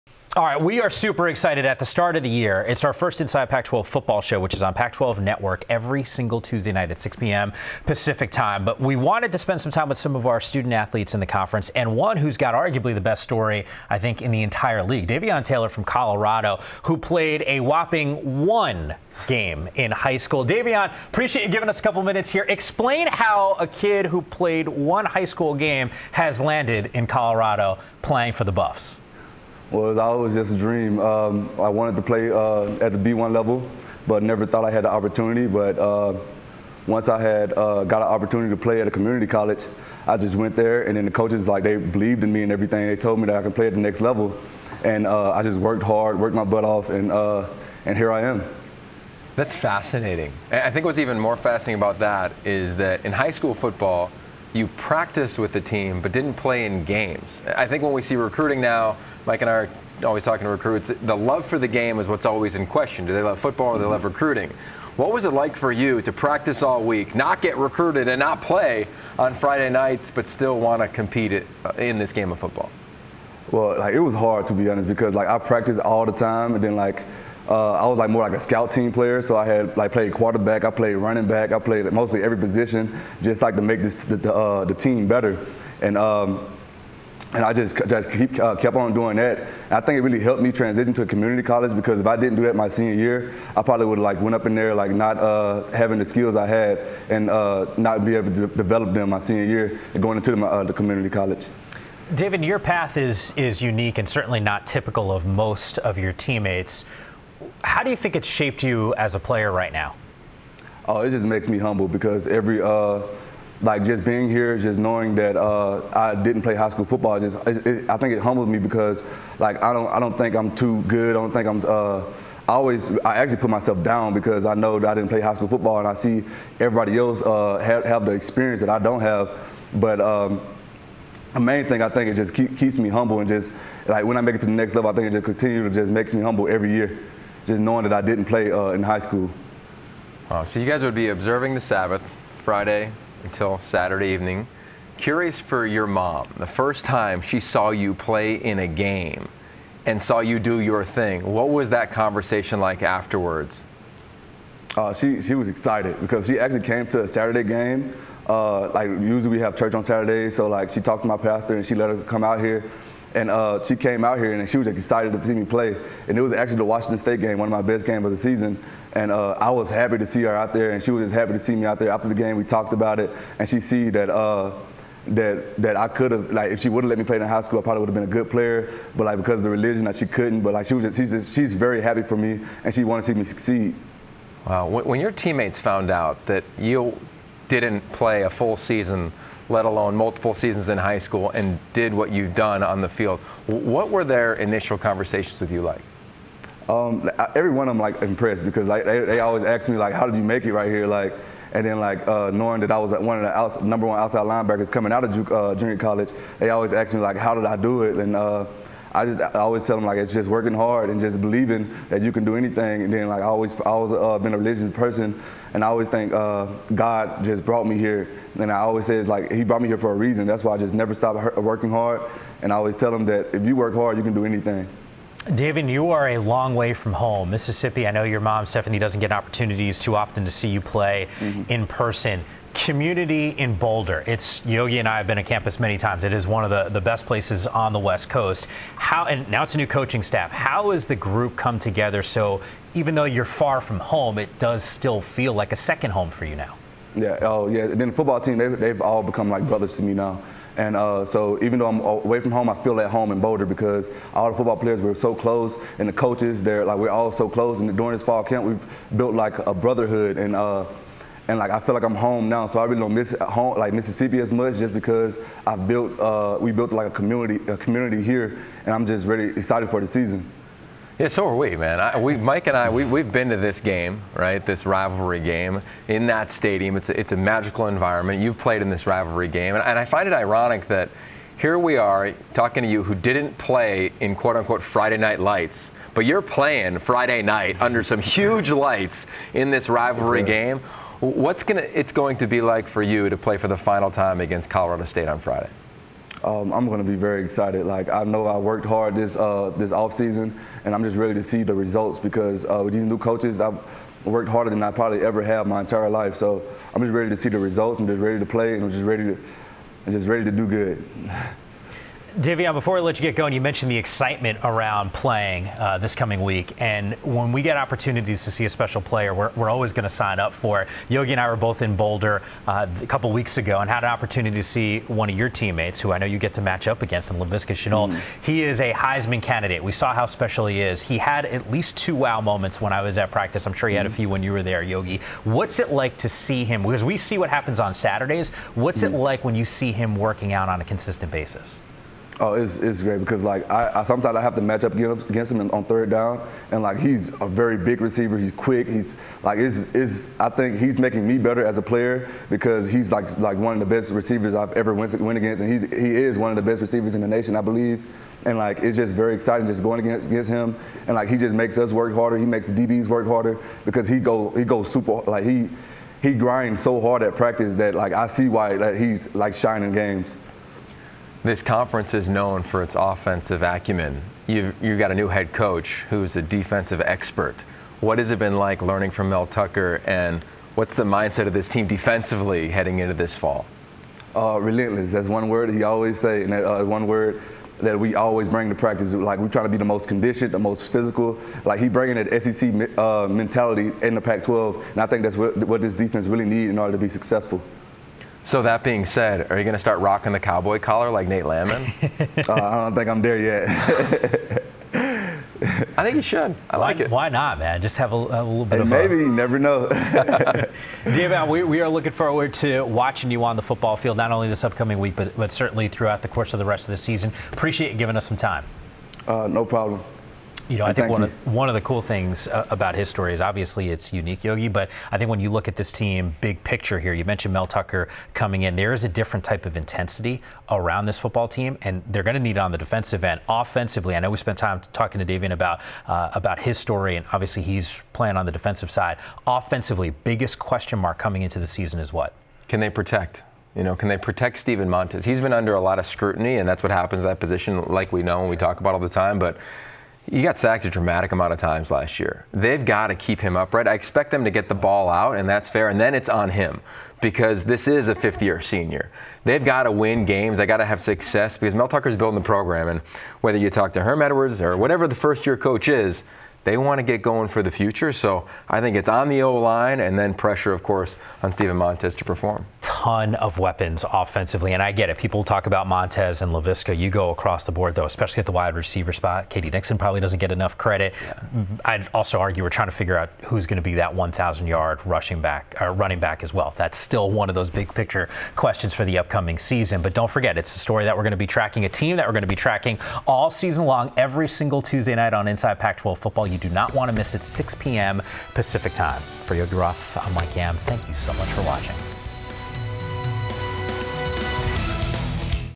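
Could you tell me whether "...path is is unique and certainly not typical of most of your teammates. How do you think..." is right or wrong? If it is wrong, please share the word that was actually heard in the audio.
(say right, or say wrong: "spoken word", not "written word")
right.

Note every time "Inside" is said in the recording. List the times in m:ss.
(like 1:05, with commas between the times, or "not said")
0:03, 8:15.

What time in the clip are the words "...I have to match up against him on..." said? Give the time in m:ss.
5:44.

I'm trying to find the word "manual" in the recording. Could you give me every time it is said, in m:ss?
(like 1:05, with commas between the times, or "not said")
not said.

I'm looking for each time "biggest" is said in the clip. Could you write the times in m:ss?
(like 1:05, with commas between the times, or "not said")
7:20.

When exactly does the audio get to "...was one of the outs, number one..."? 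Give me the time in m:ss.
3:22.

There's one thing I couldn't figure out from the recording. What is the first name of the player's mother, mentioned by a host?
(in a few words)
Stephanie.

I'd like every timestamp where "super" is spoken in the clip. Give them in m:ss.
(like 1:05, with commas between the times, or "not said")
0:00, 6:04.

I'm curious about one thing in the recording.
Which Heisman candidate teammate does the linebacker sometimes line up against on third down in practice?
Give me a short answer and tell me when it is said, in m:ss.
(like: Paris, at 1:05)
Laviska Shenault, at 5:27.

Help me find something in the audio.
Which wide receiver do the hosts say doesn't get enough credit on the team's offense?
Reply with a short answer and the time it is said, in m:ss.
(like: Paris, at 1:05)
K.D. Nixon, at 7:59.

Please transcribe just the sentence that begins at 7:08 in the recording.
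There is a different type of intensity around this football team, and they're going to need it on the defensive end.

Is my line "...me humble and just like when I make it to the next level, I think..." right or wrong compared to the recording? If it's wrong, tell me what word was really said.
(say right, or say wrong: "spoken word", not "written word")
right.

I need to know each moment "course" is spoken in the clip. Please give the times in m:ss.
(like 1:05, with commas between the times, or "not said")
6:56, 7:50.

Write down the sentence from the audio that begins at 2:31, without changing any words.
What was that conversation like afterwards?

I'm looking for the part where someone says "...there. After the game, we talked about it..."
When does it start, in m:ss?
2:51.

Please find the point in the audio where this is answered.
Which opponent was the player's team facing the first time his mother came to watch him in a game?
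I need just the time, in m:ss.
2:46.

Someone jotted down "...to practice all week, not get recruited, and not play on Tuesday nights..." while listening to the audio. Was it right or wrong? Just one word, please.
wrong.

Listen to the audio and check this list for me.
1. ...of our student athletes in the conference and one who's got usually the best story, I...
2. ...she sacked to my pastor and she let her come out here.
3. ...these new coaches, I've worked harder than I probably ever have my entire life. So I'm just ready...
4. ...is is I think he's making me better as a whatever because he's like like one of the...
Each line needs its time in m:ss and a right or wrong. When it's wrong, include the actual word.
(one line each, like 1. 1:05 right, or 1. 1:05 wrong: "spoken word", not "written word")
1. 0:10 wrong: "arguably", not "usually"
2. 2:40 wrong: "talked", not "sacked"
3. 5:02 right
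4. 5:49 wrong: "player", not "whatever".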